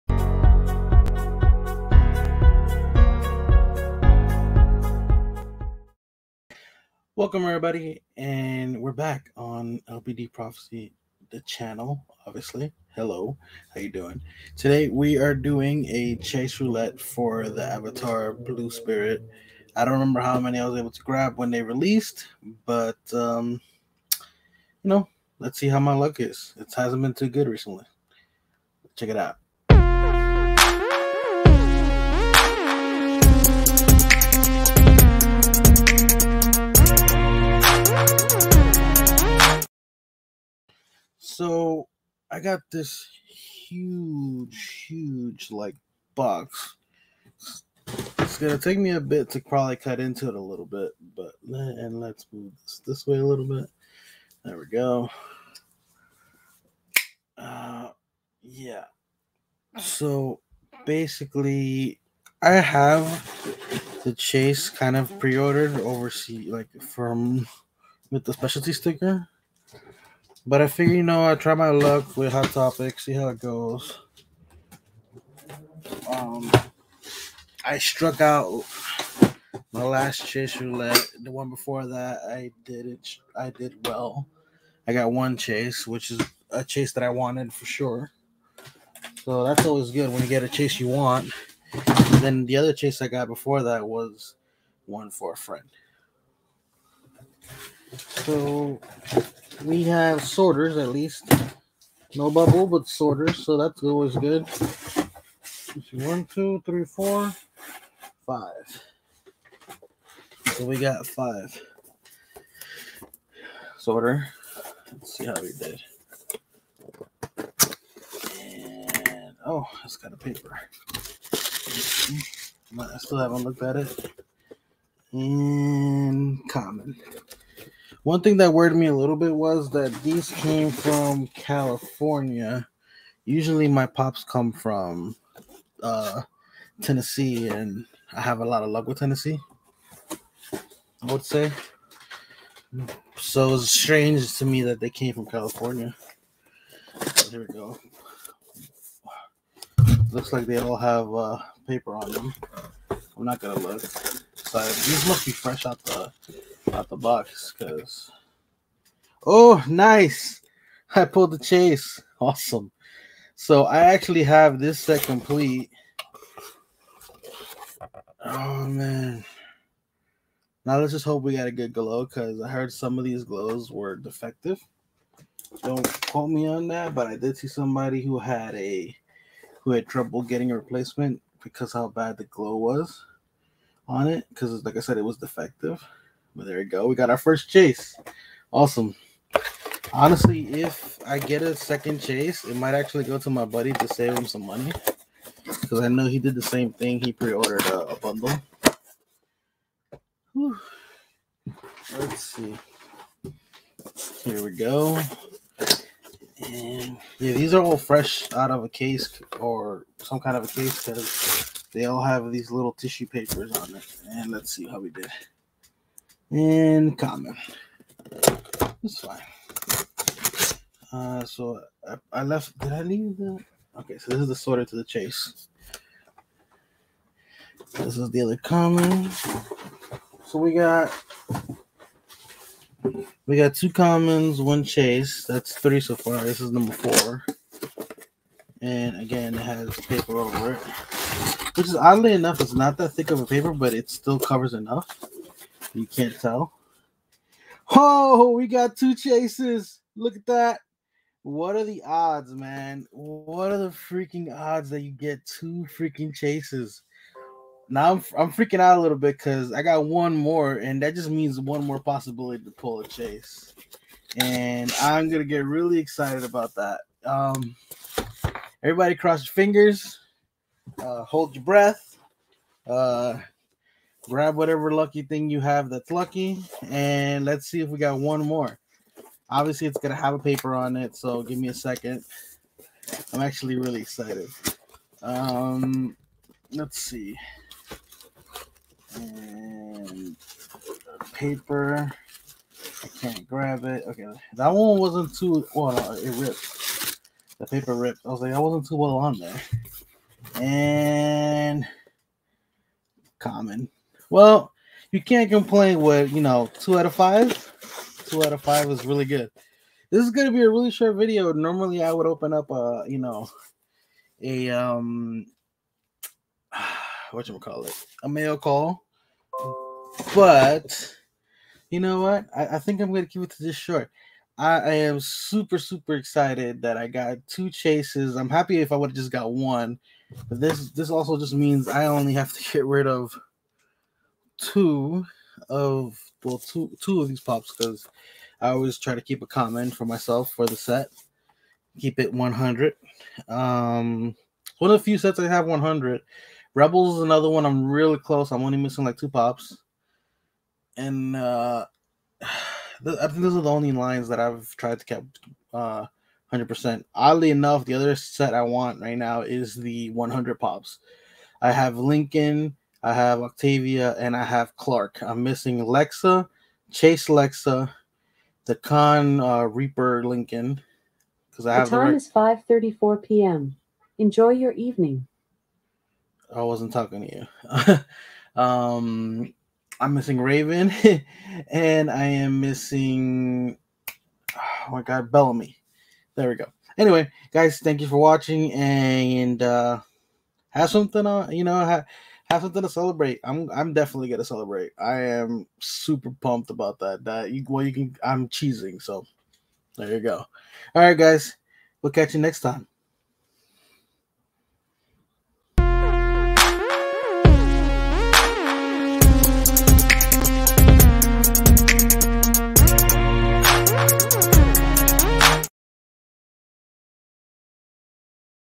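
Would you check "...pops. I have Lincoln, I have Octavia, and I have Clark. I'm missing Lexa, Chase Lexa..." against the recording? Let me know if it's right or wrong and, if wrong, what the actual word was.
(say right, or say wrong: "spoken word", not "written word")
right.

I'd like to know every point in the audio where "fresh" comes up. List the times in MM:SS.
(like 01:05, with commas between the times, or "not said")
02:35, 03:27.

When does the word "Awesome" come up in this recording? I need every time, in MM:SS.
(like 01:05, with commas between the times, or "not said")
02:42, 03:08.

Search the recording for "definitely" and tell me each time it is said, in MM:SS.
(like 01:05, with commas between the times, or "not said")
06:33.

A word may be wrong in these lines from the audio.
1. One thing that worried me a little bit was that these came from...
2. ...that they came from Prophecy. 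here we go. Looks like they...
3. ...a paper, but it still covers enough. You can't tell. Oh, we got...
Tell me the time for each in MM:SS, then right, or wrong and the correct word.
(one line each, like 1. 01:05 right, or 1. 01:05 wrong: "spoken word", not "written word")
1. 02:08 right
2. 02:24 wrong: "California", not "Prophecy"
3. 04:03 right.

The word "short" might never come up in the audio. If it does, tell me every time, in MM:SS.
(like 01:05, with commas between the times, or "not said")
05:10, 05:23.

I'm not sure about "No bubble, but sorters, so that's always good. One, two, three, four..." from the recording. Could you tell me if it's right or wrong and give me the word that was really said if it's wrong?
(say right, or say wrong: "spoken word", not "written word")
right.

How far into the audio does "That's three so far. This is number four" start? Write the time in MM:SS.
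03:55.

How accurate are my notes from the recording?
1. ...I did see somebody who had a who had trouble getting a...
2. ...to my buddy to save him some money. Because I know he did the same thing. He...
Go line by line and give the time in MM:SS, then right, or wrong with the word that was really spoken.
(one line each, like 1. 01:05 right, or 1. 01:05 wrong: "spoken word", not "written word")
1. 02:57 right
2. 03:13 right.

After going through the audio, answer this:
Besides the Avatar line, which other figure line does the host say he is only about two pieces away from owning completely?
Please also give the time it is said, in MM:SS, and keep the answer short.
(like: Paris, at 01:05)
Rebels, at 05:46.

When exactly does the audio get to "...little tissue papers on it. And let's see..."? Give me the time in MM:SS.
03:32.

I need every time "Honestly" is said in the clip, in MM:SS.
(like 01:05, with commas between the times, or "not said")
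03:09.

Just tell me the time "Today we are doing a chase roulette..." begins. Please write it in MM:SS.
00:14.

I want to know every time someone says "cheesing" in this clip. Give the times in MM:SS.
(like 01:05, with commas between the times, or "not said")
06:38.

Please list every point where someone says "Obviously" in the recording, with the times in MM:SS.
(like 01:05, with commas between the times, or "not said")
00:12, 04:39.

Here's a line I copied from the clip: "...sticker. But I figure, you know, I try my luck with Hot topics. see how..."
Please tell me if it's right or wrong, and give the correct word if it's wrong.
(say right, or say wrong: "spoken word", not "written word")
right.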